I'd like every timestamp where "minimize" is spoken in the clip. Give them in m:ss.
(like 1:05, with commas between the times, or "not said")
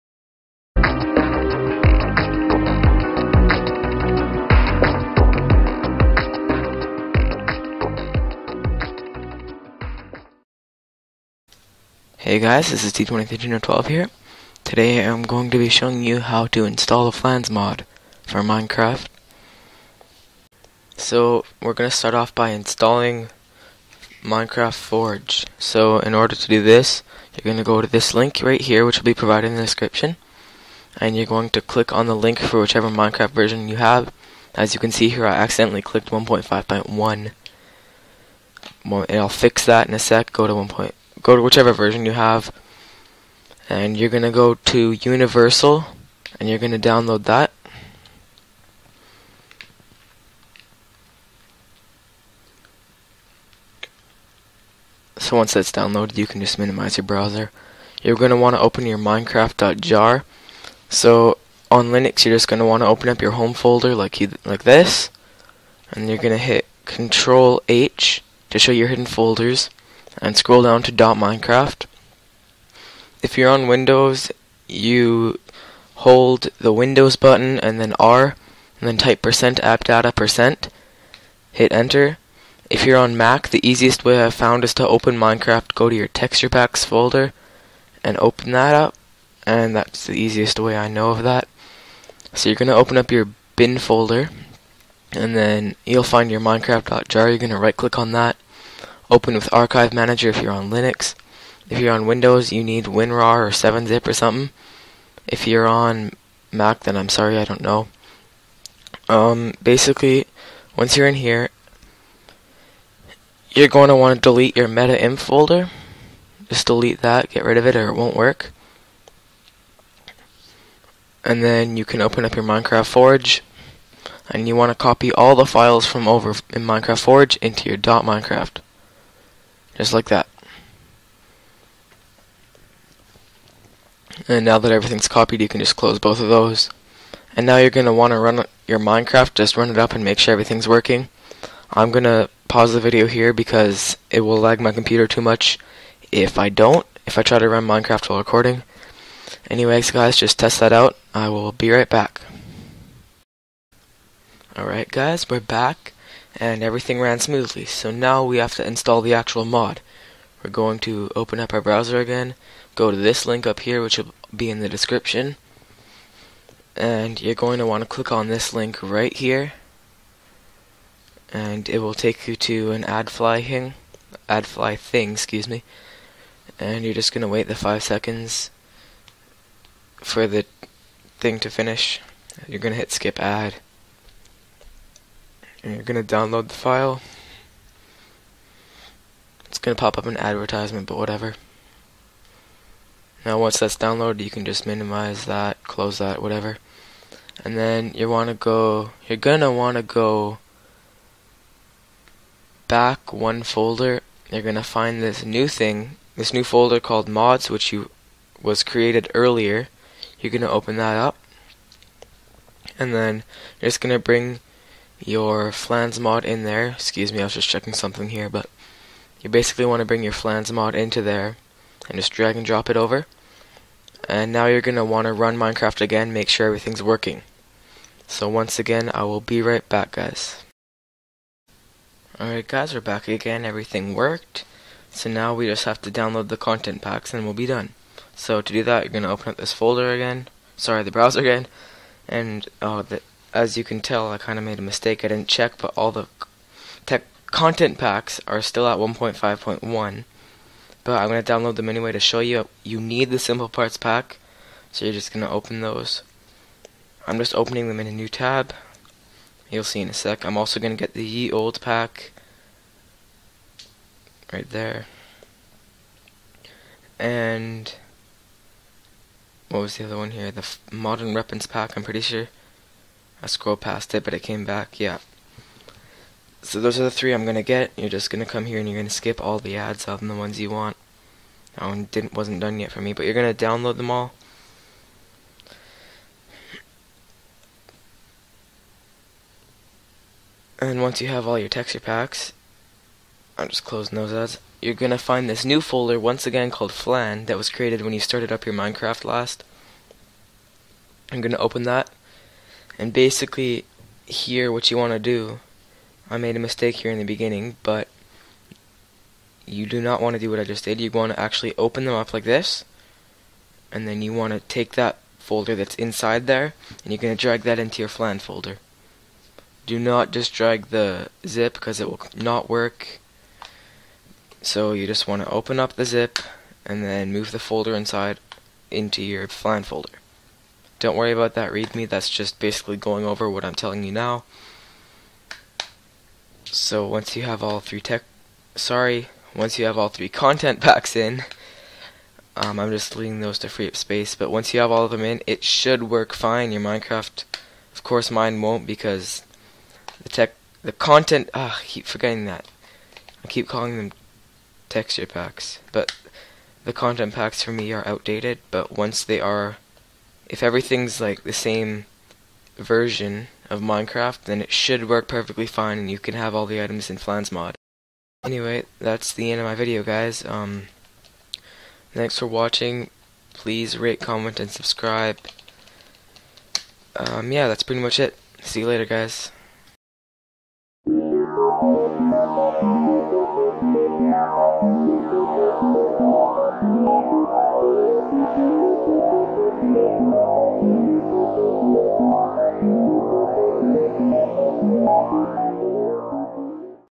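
0:56, 3:14.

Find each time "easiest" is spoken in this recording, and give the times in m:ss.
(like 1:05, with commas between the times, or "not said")
1:23, 1:30.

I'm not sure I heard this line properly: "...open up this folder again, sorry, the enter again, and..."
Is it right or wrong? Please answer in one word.
wrong.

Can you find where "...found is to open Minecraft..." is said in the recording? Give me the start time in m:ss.
1:24.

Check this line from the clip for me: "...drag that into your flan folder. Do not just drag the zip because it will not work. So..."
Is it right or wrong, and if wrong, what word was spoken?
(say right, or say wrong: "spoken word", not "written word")
right.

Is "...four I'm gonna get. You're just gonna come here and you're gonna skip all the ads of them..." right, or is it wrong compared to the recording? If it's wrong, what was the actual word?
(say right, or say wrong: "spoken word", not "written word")
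wrong: "three", not "four".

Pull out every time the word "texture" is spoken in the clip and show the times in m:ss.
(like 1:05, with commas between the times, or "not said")
1:26, 4:51, 5:54.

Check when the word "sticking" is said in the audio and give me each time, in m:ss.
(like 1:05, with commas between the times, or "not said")
not said.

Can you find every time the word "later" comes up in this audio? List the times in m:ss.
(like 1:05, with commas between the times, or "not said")
6:18.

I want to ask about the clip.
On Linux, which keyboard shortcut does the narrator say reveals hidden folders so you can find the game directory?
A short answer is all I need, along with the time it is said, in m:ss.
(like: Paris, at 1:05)
Control H, at 1:06.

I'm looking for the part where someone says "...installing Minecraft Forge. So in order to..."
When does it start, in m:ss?
0:22.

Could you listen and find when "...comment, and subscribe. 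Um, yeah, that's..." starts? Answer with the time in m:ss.
6:13.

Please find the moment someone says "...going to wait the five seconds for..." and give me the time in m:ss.
2:57.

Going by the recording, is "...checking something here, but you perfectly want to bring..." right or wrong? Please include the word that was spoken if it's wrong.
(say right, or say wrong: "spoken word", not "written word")
wrong: "basically", not "perfectly".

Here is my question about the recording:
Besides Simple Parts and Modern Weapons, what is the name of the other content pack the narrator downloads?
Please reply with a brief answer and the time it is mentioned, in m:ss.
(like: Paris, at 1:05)
Ye Olde pack, at 4:21.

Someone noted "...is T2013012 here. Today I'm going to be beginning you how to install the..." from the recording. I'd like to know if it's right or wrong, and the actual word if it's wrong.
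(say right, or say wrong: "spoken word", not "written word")
wrong: "showing", not "beginning".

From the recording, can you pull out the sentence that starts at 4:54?
You're gonna find this new folder once again called Flan that was created when you started up your Minecraft last.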